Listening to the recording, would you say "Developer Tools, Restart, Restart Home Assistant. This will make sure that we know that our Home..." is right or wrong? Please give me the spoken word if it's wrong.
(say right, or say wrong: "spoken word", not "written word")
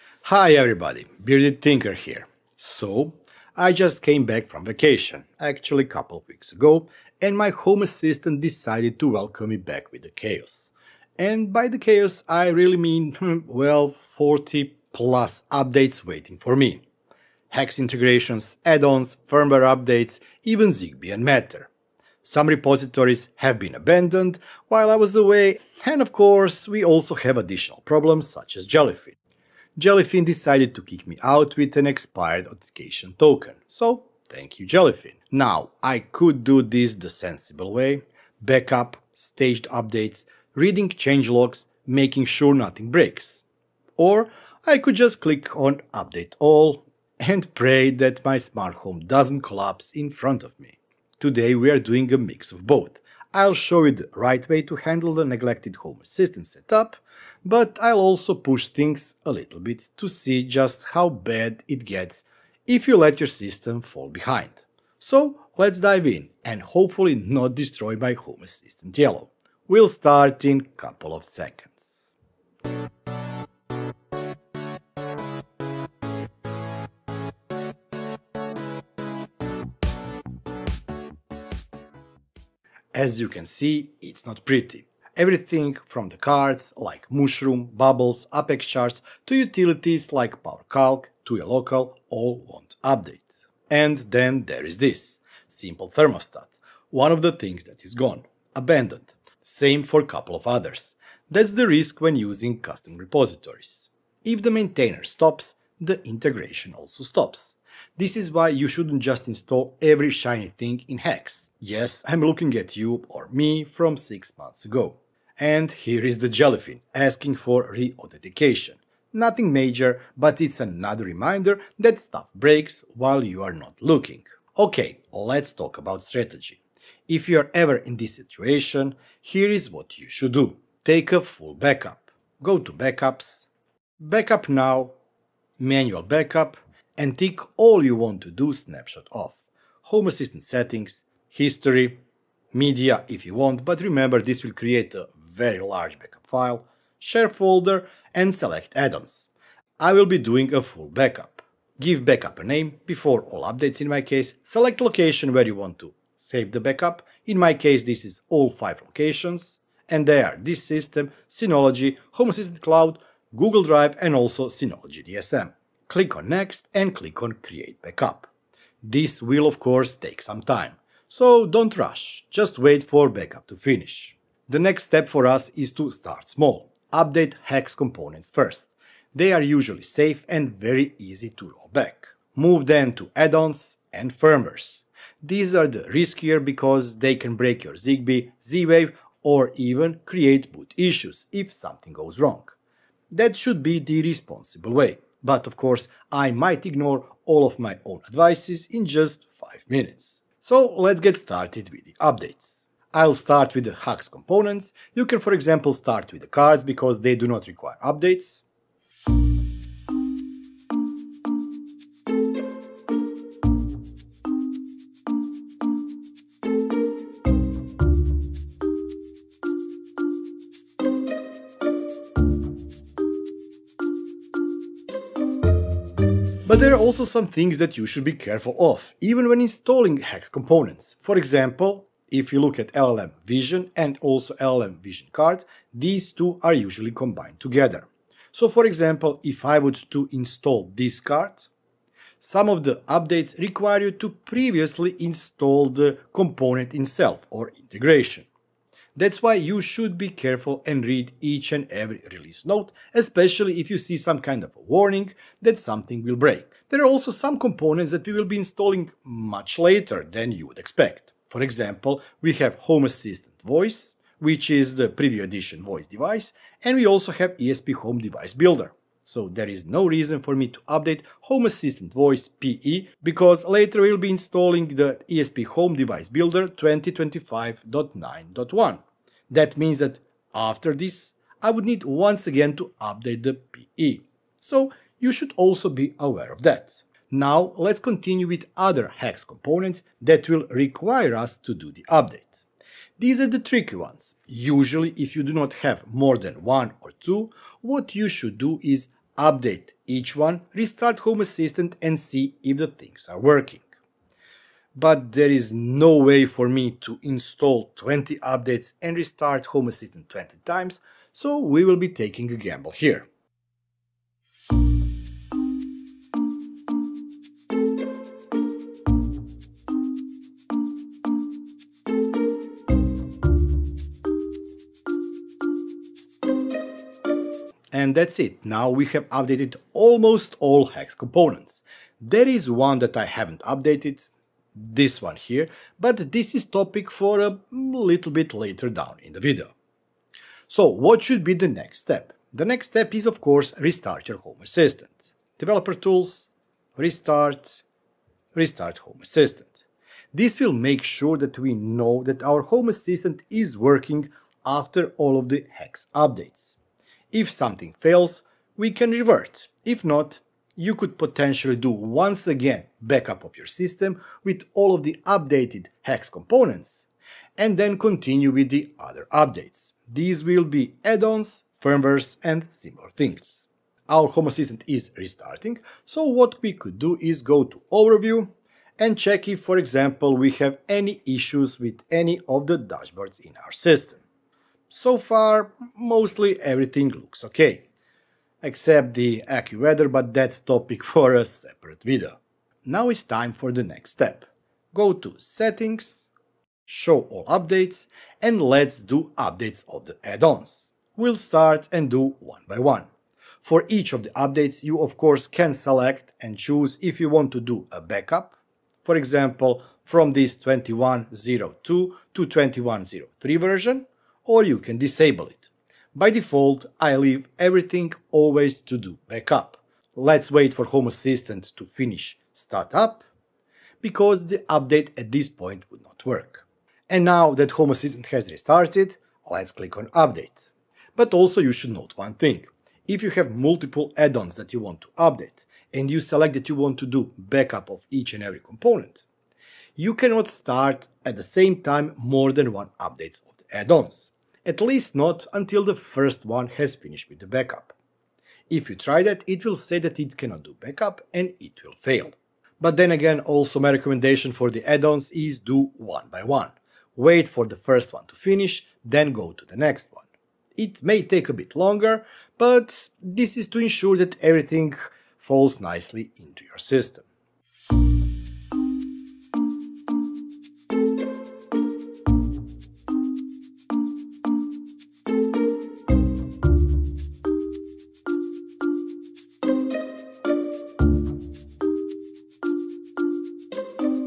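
right.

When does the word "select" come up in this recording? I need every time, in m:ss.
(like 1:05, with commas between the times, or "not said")
2:28, 2:34, 6:45, 7:15.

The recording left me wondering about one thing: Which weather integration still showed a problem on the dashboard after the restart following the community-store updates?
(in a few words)
AccuWeather.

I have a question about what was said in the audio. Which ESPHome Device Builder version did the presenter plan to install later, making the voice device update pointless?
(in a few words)
2025.9.1.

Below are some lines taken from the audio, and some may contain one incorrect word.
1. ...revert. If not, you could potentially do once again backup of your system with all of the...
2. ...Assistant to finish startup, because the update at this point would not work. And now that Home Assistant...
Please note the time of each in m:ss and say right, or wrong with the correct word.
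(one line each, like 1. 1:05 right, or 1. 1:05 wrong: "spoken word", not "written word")
1. 5:58 right
2. 7:00 right.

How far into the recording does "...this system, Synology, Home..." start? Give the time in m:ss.
2:40.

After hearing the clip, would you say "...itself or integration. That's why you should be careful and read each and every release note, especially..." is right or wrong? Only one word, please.
right.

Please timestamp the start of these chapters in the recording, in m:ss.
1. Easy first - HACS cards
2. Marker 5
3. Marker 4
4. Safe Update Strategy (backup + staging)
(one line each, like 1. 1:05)
1. 2:03
2. 6:12
3. 2:53
4. 1:21.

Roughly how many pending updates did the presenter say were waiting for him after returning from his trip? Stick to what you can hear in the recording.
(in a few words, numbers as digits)
40 plus.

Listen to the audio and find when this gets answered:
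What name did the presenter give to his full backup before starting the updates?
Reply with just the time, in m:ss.
2:32.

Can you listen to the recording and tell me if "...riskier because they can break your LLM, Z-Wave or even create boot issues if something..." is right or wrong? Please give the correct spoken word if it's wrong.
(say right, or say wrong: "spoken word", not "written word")
wrong: "ZigBee", not "LLM".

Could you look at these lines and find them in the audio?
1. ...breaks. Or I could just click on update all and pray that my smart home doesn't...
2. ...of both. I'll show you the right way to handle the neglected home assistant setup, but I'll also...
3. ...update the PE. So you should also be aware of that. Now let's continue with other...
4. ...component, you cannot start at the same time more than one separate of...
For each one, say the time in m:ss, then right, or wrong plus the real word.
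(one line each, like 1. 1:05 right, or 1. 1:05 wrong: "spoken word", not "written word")
1. 0:42 right
2. 0:52 right
3. 4:42 right
4. 7:18 wrong: "update", not "separate".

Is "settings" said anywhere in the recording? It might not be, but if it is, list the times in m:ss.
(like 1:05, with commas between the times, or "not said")
2:20, 6:35.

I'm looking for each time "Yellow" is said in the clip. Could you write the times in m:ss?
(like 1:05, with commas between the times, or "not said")
1:08.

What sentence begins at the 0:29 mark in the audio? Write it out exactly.
Jellyfin decided to kick me out with an expired authentication token.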